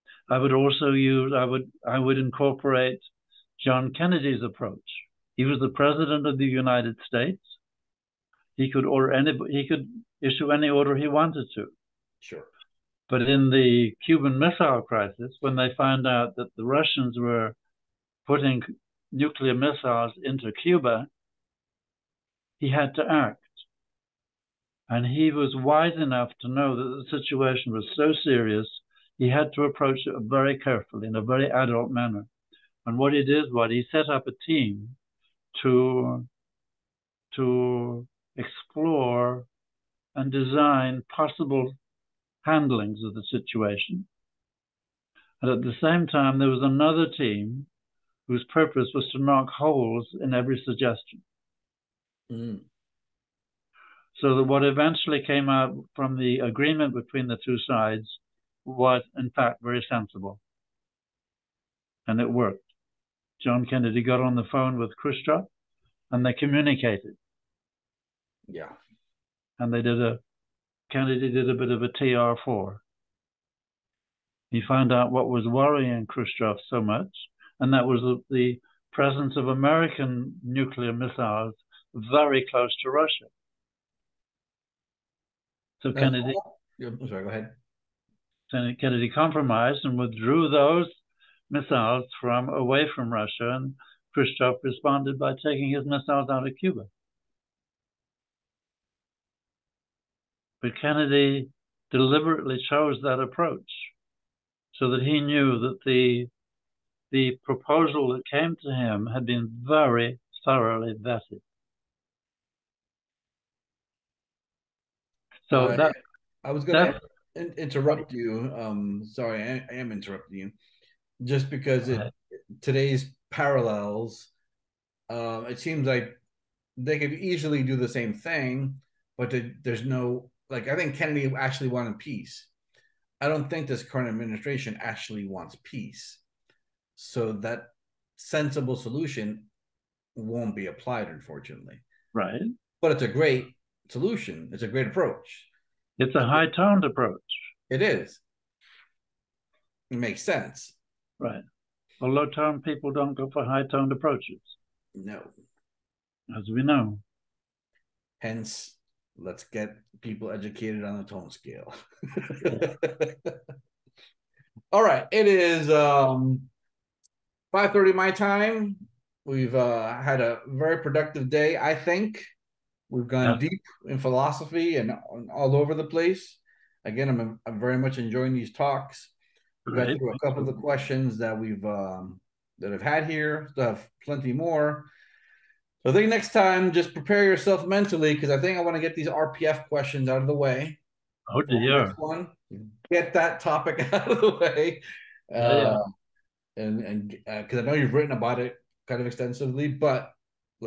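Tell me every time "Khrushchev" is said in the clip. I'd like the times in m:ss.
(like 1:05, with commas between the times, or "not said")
1:04, 1:16, 1:34.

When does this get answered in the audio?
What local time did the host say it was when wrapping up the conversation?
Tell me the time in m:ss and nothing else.
2:47.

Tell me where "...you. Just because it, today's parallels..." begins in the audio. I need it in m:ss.
2:00.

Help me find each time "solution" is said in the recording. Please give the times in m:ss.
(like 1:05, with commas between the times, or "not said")
2:18, 2:23.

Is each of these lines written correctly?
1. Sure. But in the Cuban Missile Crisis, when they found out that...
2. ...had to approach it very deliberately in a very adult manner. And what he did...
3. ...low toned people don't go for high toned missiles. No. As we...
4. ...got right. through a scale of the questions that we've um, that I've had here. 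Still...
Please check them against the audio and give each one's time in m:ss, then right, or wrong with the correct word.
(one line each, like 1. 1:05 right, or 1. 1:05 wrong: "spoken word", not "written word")
1. 0:12 right
2. 0:29 wrong: "carefully", not "deliberately"
3. 2:32 wrong: "approaches", not "missiles"
4. 2:59 wrong: "couple", not "scale".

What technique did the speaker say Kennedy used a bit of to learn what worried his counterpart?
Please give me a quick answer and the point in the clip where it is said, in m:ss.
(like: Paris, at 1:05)
TR4, at 1:11.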